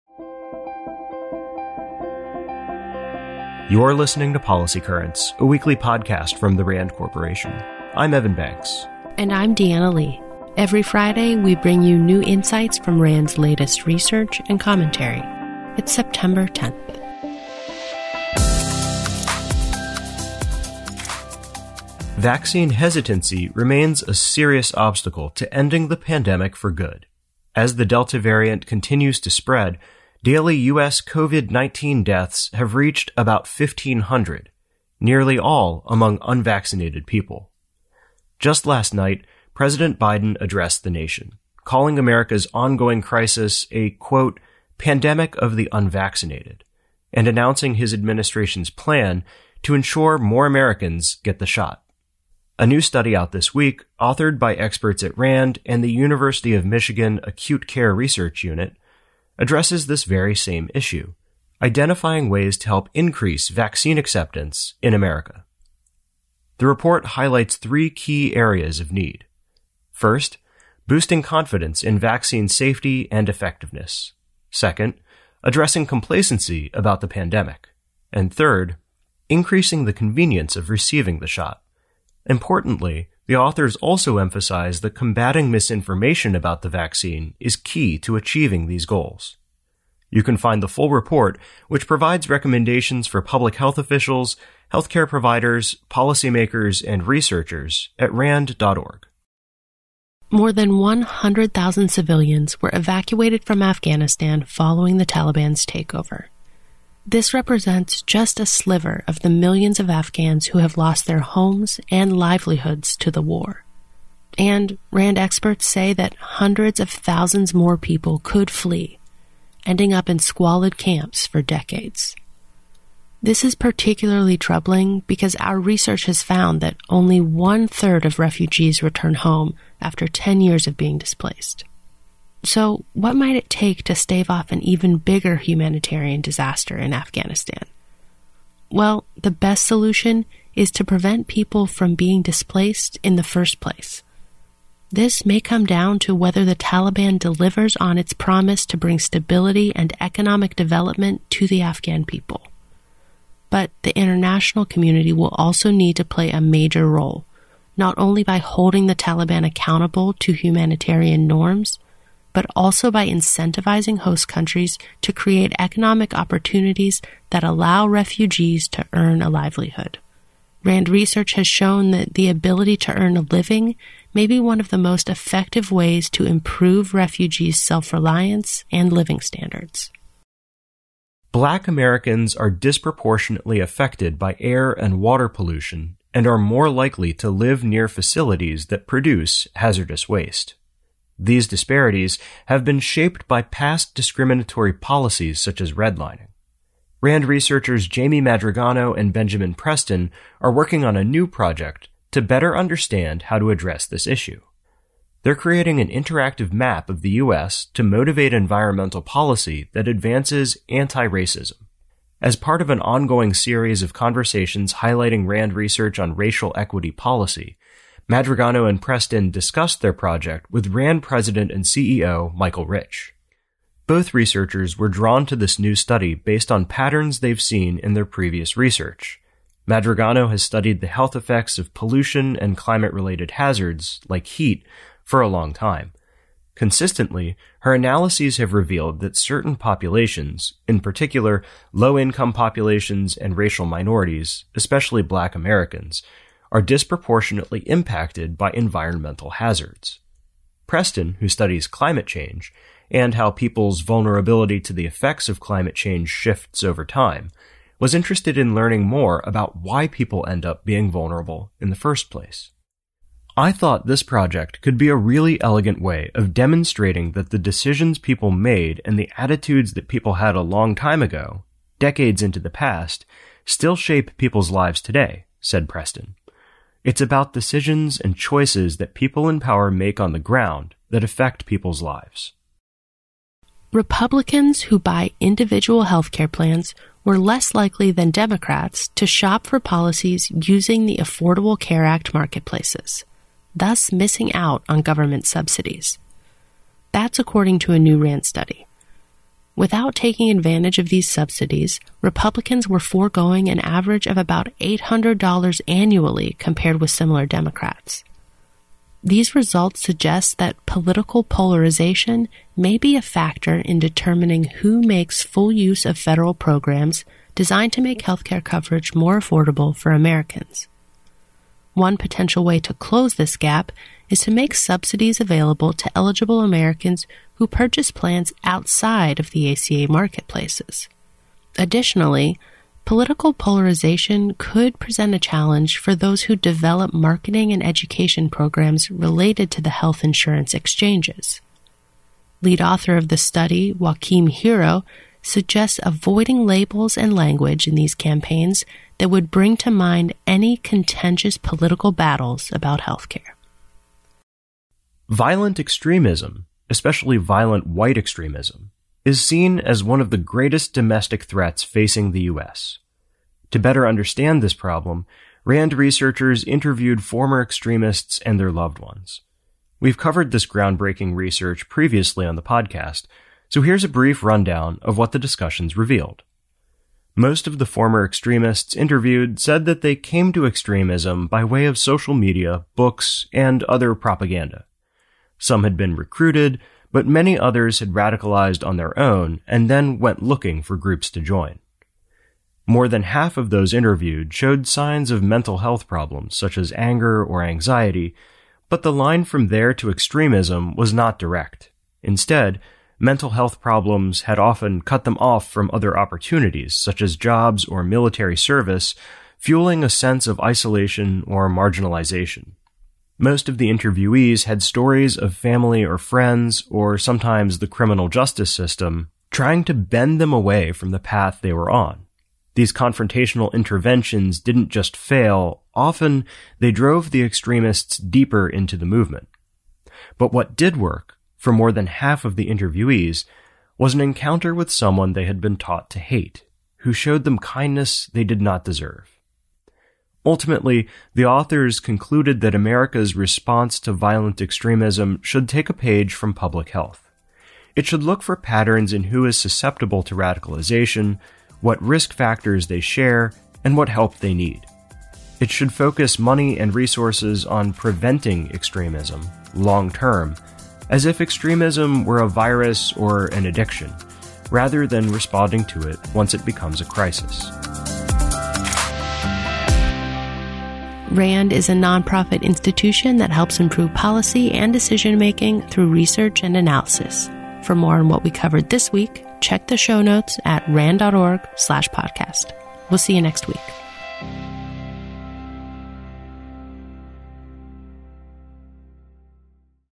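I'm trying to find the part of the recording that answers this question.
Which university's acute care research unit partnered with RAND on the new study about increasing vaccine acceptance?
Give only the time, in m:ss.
0:55.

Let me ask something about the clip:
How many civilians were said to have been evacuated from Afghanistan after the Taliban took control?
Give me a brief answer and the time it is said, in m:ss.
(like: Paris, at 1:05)
More than 100,000, at 1:40.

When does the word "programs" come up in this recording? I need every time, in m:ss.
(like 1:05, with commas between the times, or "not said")
5:16, 5:38.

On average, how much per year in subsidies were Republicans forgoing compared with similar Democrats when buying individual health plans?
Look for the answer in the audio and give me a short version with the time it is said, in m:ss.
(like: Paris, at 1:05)
$800, at 5:04.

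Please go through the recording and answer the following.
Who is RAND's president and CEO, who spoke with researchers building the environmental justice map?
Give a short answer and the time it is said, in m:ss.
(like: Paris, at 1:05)
Michael Rich, at 3:42.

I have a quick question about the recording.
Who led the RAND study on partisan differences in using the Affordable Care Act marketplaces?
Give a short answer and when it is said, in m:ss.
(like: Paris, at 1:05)
Joachim Hero, at 5:43.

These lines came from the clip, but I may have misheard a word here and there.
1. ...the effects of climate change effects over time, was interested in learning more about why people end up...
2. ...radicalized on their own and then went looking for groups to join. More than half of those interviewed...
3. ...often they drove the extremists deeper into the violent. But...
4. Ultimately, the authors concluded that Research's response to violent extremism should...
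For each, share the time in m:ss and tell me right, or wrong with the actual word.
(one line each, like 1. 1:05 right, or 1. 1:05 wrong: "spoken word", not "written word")
1. 4:14 wrong: "shifts", not "effects"
2. 6:27 right
3. 7:05 wrong: "movement", not "violent"
4. 7:20 wrong: "America", not "Research".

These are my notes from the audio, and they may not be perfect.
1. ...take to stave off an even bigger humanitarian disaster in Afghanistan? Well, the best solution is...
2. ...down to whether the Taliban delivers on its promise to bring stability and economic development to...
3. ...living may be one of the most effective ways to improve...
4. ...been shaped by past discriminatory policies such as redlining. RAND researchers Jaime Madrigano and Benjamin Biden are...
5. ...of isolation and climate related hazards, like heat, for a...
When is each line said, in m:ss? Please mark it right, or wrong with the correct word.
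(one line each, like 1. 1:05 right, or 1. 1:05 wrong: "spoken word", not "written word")
1. 2:13 right
2. 2:25 right
3. 2:53 right
4. 3:12 wrong: "Preston", not "Biden"
5. 3:51 wrong: "pollution", not "isolation".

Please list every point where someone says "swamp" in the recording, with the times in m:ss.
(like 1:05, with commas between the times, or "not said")
not said.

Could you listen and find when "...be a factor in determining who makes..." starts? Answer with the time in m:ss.
5:12.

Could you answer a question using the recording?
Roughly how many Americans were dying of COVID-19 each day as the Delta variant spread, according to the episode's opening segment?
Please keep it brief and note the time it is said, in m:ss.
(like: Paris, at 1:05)
1,500, at 0:33.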